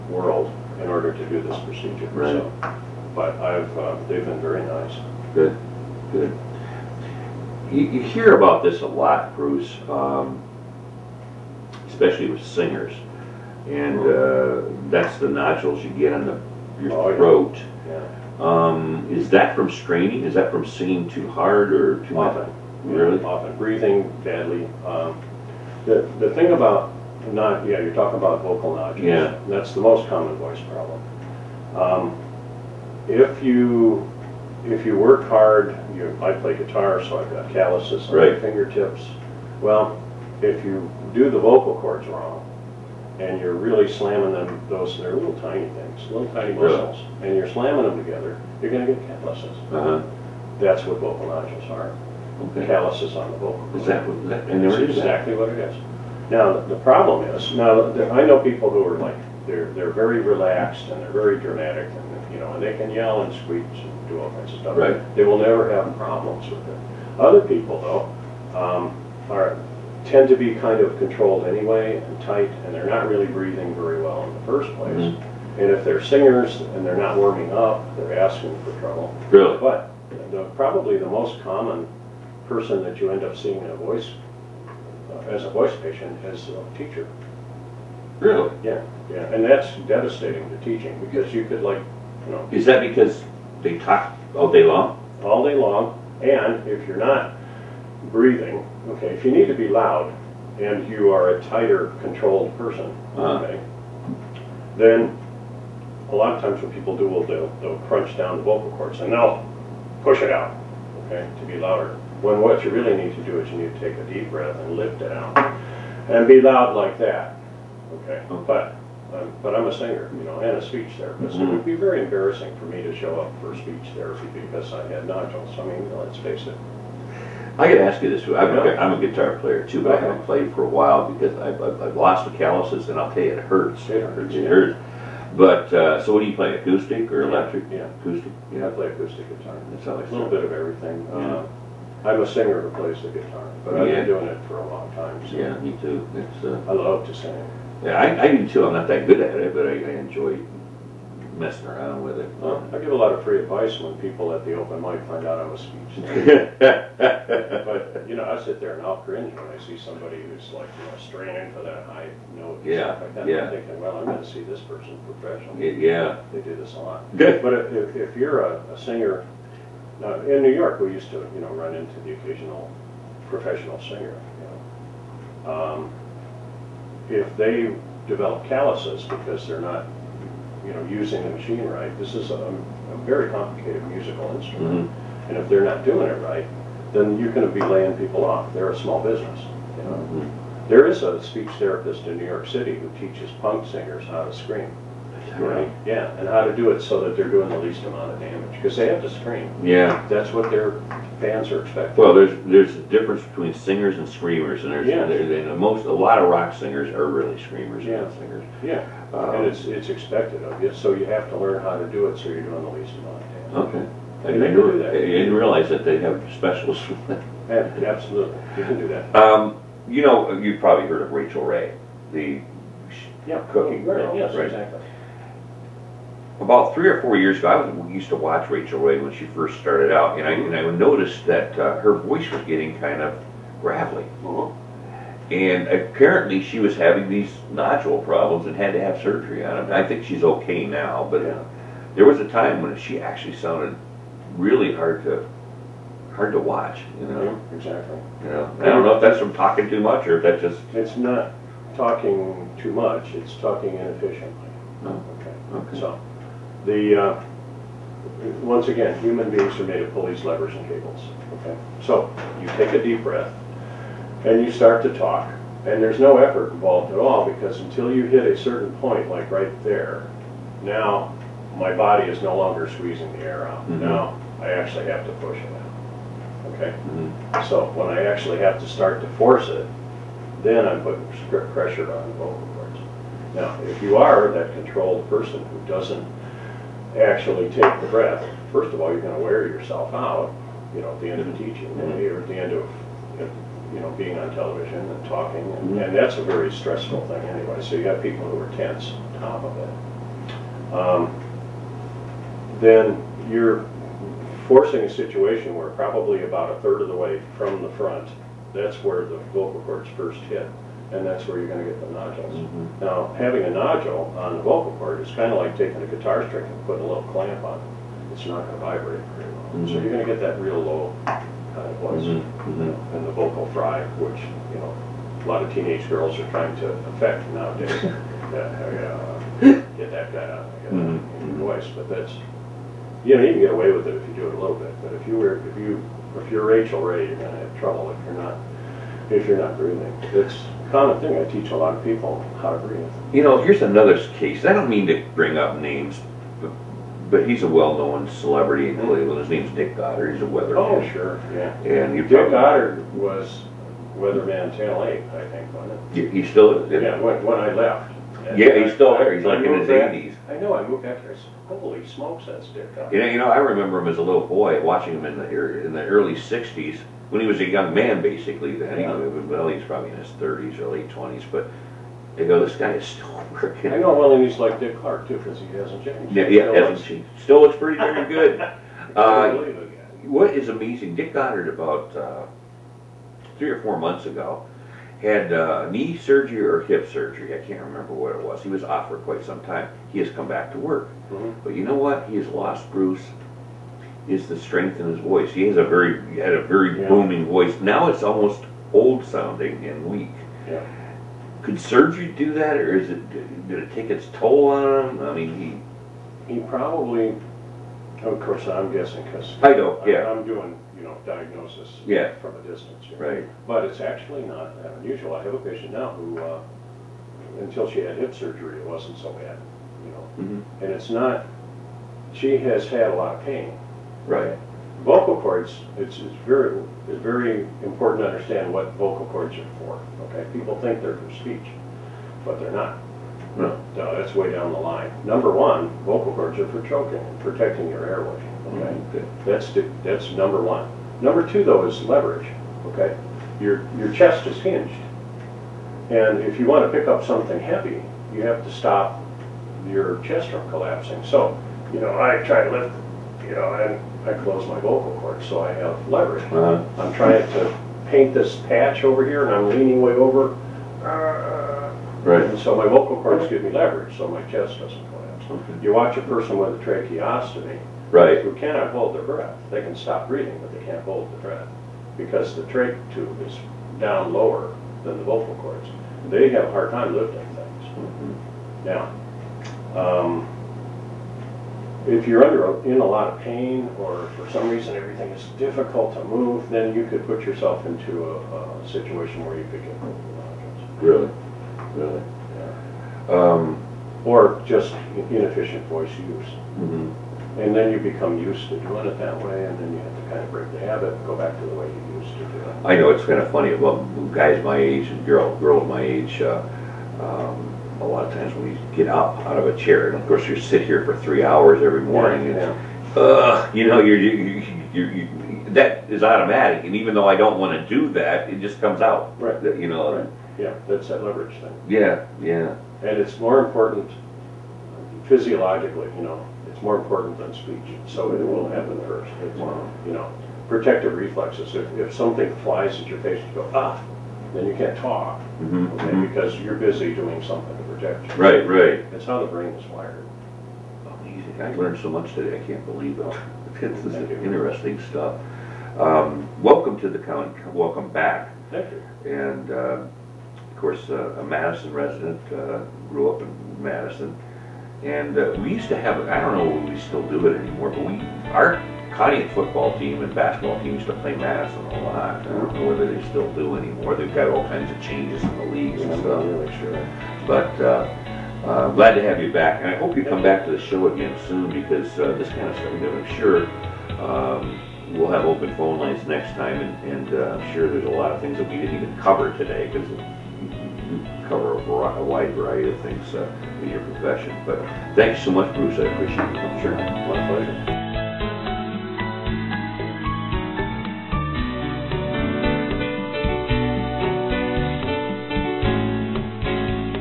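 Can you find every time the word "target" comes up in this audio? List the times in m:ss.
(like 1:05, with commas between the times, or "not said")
not said.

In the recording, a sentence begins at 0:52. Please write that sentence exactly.
calluses on the vocal Is that, what- that- and there it is.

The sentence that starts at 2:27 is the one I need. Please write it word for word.
yeah, I, I do too, I'm not that good at it, but I, I enjoy messing around with it.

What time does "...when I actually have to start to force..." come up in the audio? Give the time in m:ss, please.
4:37.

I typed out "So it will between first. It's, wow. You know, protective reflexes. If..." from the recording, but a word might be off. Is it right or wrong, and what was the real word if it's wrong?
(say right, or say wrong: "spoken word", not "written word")
wrong: "happen", not "between".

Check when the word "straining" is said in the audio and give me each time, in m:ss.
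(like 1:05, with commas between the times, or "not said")
0:19, 2:40.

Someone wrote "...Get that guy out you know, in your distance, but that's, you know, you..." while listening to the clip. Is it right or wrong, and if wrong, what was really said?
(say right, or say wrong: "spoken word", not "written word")
wrong: "voice", not "distance".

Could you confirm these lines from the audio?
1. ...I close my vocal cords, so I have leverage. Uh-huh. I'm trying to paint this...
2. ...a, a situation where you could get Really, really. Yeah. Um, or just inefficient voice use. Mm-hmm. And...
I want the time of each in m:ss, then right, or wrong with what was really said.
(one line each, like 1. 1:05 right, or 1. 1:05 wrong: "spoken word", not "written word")
1. 7:34 right
2. 8:08 right.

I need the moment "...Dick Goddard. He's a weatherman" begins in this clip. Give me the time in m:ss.
5:49.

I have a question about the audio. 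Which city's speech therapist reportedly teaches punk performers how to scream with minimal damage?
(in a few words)
New York City.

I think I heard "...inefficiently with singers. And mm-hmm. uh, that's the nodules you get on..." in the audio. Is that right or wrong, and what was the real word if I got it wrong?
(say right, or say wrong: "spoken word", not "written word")
wrong: "especially", not "inefficiently".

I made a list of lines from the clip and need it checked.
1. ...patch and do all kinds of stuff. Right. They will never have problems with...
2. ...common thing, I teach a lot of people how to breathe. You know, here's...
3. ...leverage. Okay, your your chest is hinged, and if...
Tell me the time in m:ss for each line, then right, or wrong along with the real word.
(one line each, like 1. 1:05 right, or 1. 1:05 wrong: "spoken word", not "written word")
1. 1:03 wrong: "screech", not "patch"
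2. 5:40 right
3. 7:21 right.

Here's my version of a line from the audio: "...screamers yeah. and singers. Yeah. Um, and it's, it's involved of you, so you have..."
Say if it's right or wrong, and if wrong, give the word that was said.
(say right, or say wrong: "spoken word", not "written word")
wrong: "expected", not "involved".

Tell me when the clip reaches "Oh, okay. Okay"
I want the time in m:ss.
4:14.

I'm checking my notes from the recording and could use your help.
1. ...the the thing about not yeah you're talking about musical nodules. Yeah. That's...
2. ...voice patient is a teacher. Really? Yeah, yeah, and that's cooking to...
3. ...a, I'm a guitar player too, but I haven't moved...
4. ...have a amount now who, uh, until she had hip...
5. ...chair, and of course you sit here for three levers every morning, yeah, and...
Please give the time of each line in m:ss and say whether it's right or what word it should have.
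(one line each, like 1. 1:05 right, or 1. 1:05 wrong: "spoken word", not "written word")
1. 0:25 wrong: "vocal", not "musical"
2. 1:25 wrong: "devastating", not "cooking"
3. 2:08 wrong: "played", not "moved"
4. 6:55 wrong: "patient", not "amount"
5. 8:29 wrong: "hours", not "levers".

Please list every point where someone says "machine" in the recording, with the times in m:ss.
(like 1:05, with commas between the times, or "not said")
3:01.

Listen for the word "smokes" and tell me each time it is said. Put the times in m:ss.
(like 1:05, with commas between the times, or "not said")
6:01.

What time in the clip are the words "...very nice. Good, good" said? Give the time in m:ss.
0:04.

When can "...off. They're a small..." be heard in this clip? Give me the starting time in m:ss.
3:08.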